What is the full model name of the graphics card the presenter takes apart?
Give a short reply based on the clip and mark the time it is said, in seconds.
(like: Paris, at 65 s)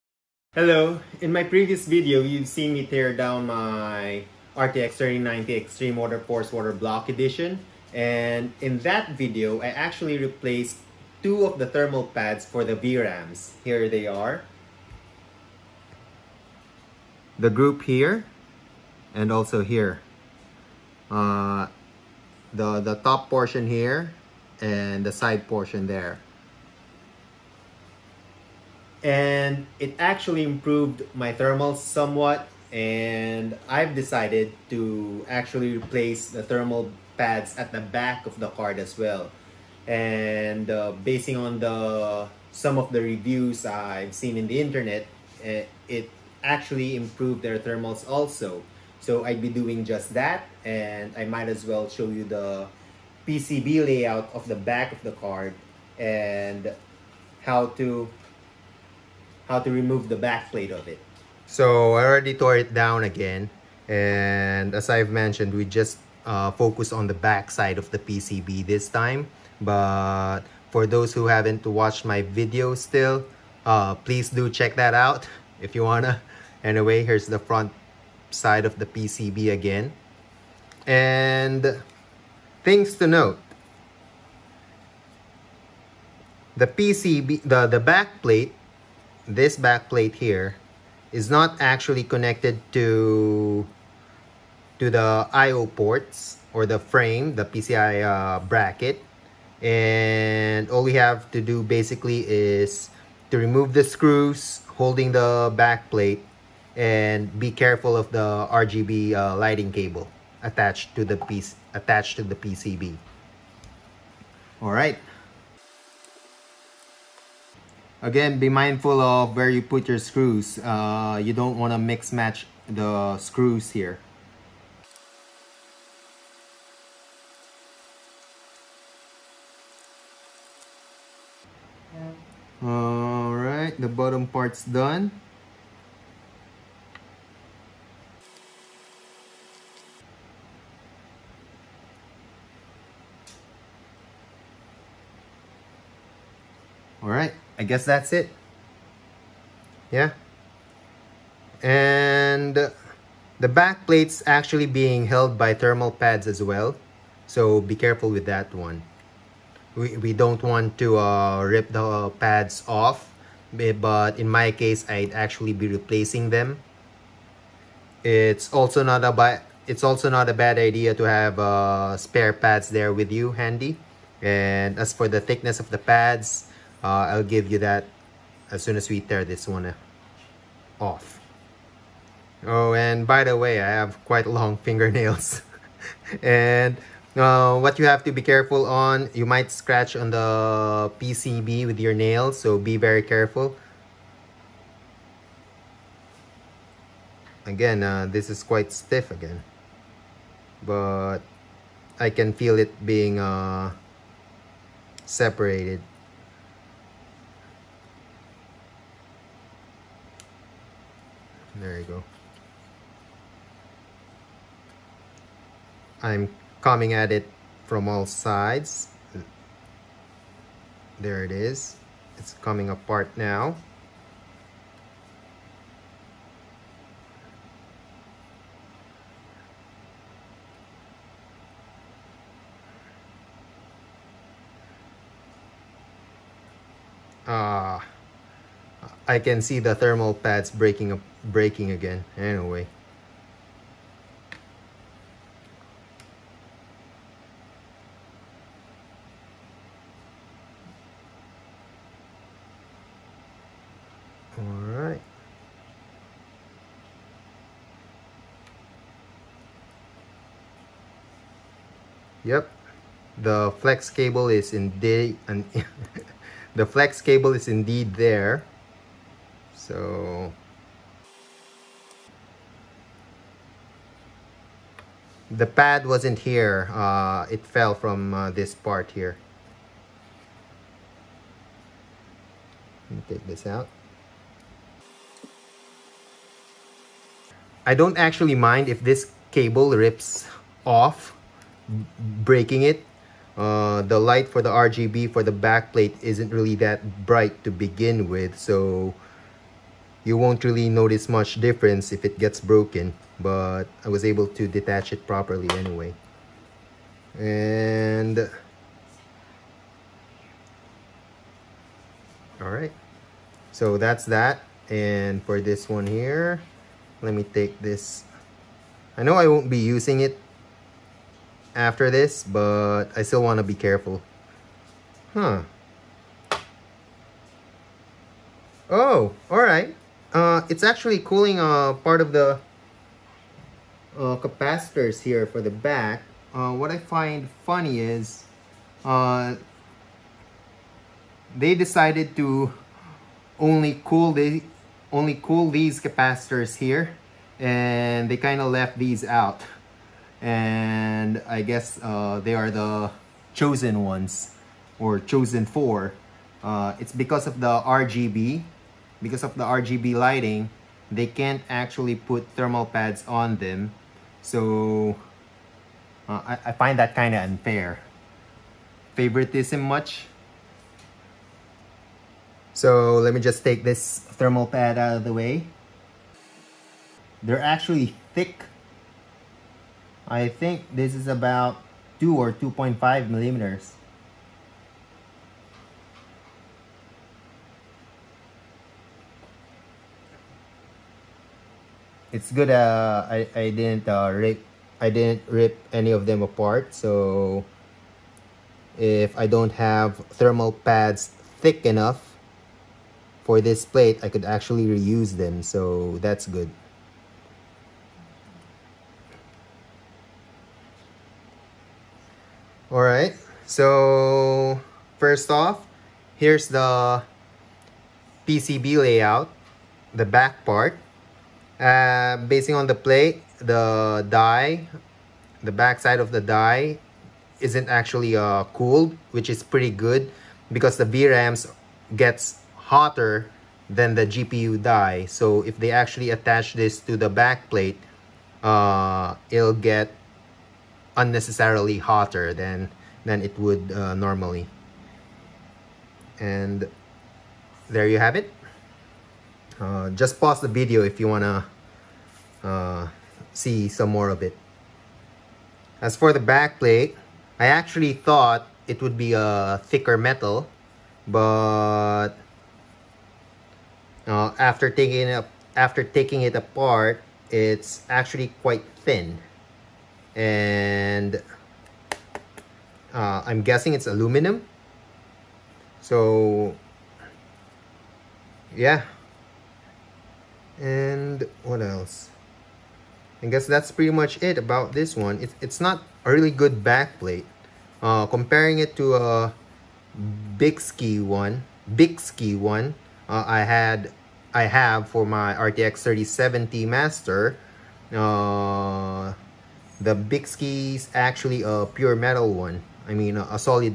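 RTX 3090 Xtreme WaterForce, at 4 s.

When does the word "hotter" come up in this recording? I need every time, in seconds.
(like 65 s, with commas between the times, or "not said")
432 s, 441 s.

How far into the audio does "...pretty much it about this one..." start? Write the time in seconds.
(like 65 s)
483 s.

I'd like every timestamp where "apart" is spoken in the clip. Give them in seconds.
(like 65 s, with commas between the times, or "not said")
222 s, 396 s, 466 s.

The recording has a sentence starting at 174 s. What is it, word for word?
And as for the thickness of the pads, uh, I'll give you that as soon as we tear this one uh, off.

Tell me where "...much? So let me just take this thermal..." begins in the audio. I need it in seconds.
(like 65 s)
369 s.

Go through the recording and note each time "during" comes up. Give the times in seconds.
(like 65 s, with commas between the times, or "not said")
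not said.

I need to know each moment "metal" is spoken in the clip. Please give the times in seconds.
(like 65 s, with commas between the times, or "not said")
459 s, 501 s.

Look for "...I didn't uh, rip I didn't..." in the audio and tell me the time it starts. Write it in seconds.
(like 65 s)
393 s.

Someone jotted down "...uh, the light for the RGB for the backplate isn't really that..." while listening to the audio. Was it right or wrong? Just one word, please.
right.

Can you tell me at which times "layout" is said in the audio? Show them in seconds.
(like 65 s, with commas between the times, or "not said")
53 s, 418 s.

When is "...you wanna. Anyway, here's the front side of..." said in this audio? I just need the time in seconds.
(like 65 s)
75 s.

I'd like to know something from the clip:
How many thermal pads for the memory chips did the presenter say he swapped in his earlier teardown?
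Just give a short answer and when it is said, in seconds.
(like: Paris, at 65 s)
2, at 11 s.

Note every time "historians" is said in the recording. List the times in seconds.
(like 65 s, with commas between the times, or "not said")
not said.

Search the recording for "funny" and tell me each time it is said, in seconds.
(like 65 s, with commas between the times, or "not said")
337 s.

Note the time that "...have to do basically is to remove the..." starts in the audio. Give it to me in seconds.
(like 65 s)
100 s.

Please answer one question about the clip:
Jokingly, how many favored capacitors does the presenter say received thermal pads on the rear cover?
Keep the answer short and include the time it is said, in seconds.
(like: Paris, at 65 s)
4, at 355 s.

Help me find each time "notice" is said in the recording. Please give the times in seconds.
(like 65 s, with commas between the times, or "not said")
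300 s.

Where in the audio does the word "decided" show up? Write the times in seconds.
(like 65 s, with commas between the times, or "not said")
33 s, 341 s.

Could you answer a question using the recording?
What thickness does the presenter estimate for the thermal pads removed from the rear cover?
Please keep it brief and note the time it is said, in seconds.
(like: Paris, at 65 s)
2 or 2.5 millimeters, at 382 s.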